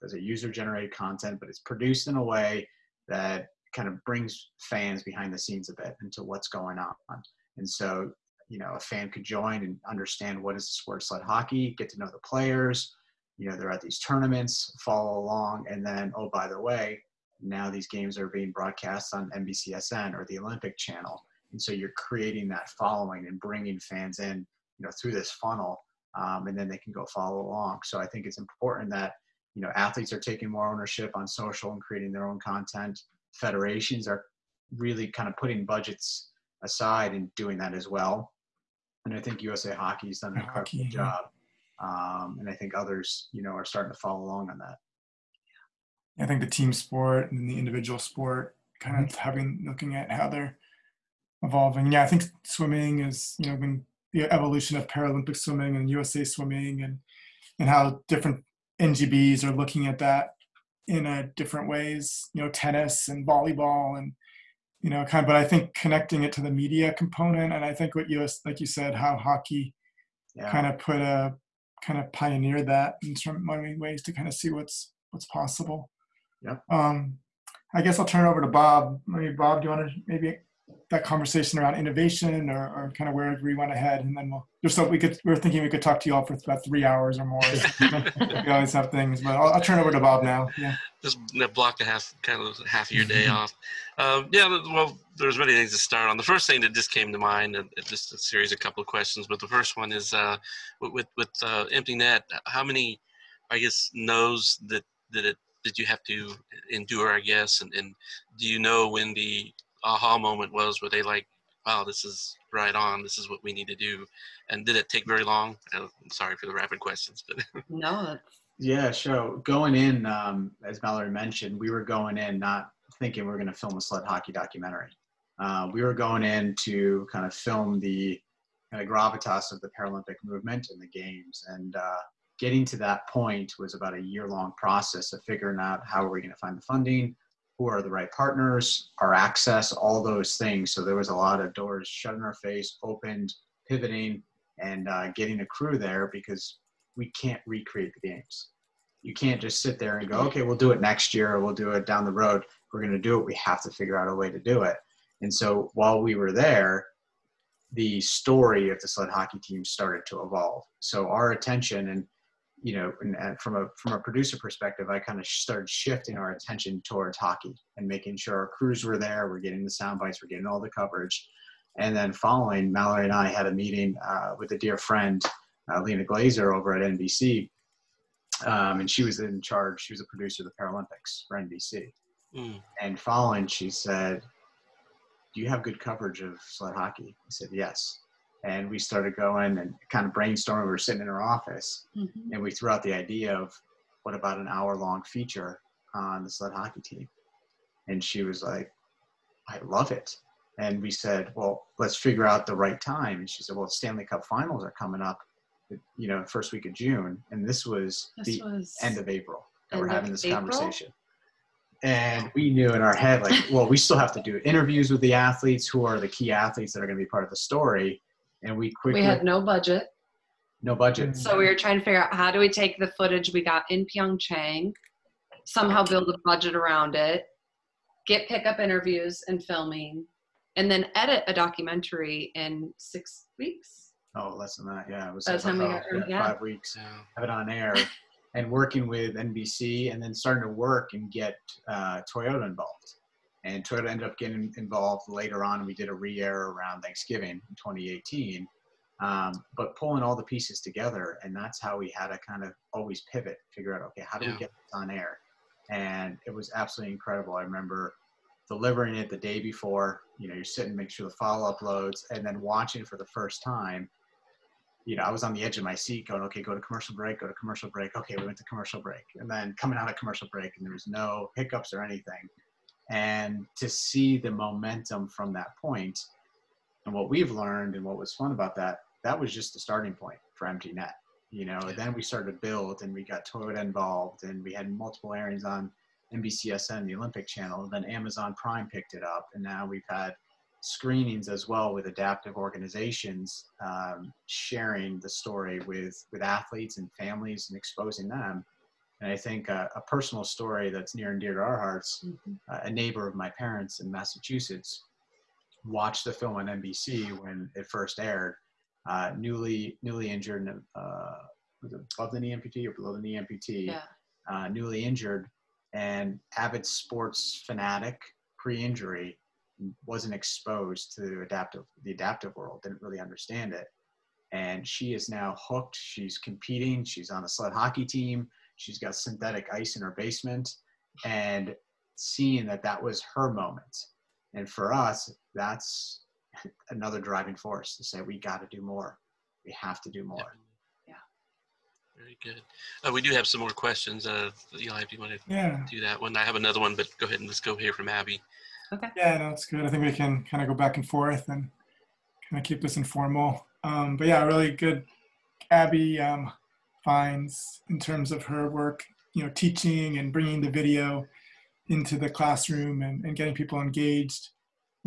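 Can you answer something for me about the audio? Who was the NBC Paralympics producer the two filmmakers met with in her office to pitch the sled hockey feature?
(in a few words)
Lena Glazer.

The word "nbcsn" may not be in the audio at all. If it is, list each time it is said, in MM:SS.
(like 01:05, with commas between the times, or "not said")
00:19, 04:46.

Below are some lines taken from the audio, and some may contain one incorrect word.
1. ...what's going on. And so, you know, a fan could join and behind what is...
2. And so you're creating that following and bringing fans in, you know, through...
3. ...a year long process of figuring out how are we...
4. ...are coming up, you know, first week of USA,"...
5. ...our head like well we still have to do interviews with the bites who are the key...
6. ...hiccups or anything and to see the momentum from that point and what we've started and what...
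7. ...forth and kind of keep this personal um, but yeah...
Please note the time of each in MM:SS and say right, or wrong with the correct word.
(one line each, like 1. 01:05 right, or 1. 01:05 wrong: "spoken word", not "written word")
1. 00:06 wrong: "understand", not "behind"
2. 00:21 right
3. 02:13 right
4. 03:24 wrong: "June", not "USA"
5. 03:32 wrong: "athletes", not "bites"
6. 04:31 wrong: "learned", not "started"
7. 05:50 wrong: "informal", not "personal".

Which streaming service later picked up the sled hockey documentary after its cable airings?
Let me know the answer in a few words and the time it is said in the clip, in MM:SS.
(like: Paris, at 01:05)
Amazon Prime, at 04:47.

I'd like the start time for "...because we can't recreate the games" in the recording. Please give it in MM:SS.
02:26.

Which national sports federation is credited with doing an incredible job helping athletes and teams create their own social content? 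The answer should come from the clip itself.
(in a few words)
USA Hockey.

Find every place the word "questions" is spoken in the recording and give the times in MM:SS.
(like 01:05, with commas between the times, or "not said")
01:38, 01:56, 05:43.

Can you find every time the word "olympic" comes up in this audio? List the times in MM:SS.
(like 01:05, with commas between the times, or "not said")
00:20, 04:46.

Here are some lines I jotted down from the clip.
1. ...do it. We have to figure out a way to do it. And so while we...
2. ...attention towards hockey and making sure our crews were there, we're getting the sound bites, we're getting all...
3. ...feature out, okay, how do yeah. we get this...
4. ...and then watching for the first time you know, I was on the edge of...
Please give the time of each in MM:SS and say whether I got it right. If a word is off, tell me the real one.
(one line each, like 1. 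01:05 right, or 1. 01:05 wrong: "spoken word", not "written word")
1. 02:32 right
2. 02:46 right
3. 04:13 wrong: "figure", not "feature"
4. 04:22 right.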